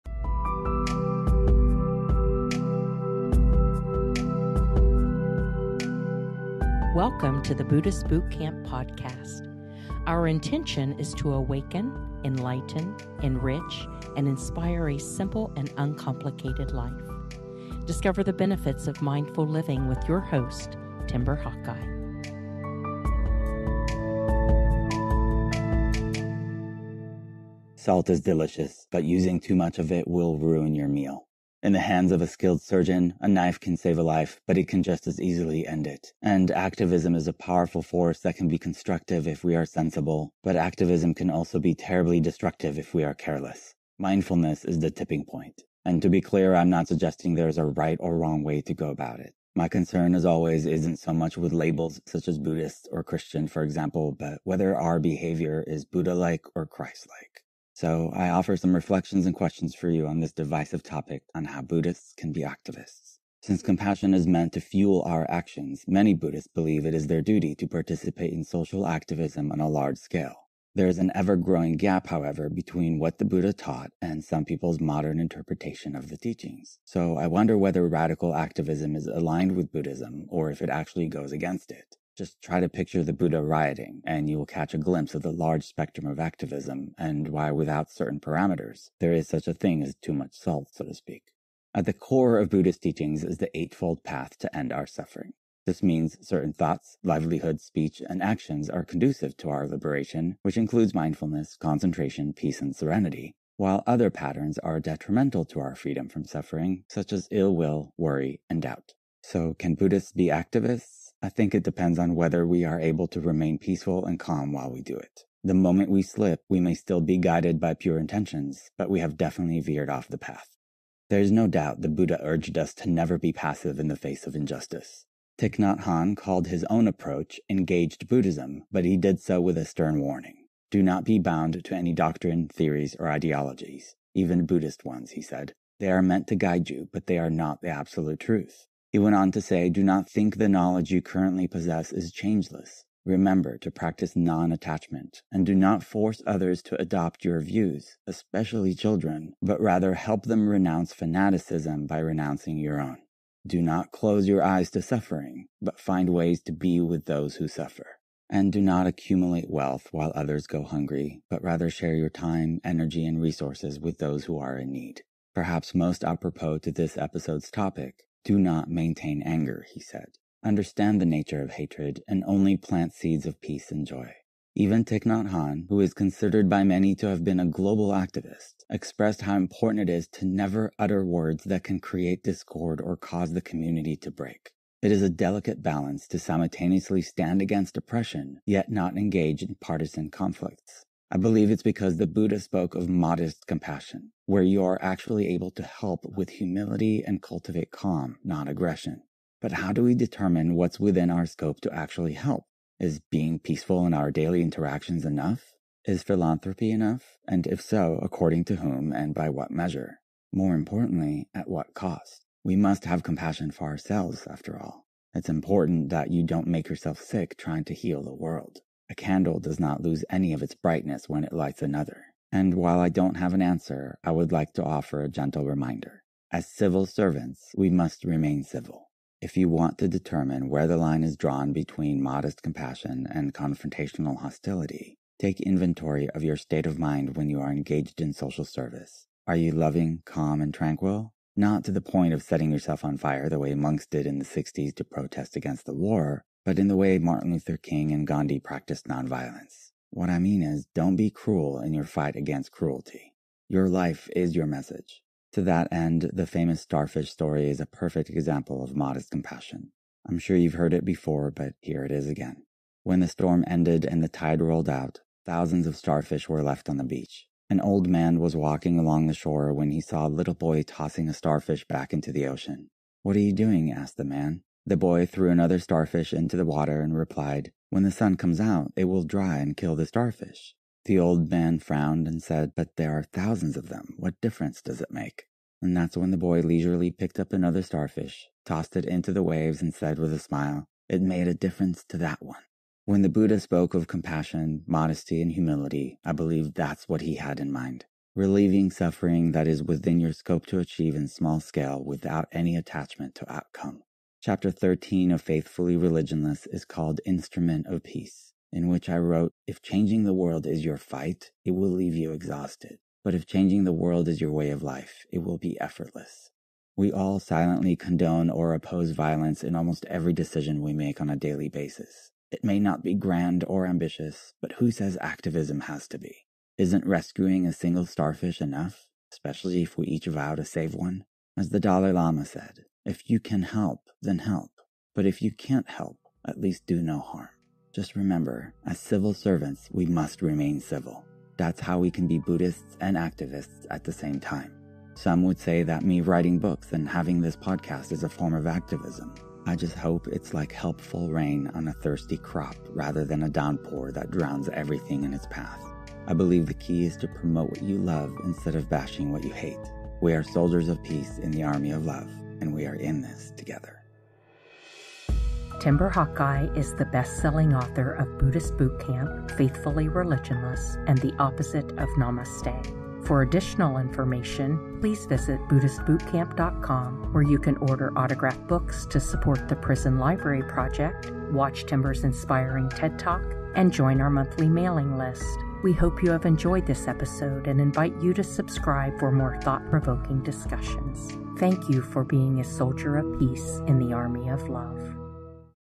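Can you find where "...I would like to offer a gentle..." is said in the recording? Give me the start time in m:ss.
3:44.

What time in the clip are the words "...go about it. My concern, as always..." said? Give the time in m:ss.
0:48.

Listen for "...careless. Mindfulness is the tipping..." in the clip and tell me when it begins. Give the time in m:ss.
0:43.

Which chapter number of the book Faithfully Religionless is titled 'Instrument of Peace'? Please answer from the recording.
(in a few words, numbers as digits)
13.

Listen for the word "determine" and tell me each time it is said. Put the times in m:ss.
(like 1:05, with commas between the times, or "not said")
3:19, 3:49.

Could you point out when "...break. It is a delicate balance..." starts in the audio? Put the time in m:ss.
3:04.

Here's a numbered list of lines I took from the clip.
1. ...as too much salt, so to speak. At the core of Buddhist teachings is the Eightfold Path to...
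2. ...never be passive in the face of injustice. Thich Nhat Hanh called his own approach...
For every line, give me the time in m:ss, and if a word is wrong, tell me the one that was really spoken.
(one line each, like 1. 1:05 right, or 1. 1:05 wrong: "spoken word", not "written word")
1. 1:29 right
2. 2:02 right.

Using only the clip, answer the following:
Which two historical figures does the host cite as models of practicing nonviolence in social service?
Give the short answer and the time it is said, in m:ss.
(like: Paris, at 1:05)
Martin Luther King and Gandhi, at 4:06.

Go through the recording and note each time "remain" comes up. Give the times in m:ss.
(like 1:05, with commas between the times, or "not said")
1:53, 3:48, 5:40.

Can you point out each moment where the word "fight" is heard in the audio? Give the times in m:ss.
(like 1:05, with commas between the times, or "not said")
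4:11, 5:10.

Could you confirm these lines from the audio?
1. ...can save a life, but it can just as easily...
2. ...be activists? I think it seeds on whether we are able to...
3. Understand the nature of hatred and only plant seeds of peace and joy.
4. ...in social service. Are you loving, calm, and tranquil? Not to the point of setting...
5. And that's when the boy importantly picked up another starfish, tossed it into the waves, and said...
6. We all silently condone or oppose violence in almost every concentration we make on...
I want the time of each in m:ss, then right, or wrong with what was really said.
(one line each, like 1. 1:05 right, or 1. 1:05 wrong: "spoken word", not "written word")
1. 0:33 right
2. 1:50 wrong: "depends", not "seeds"
3. 2:50 right
4. 3:58 right
5. 4:45 wrong: "leisurely", not "importantly"
6. 5:16 wrong: "decision", not "concentration".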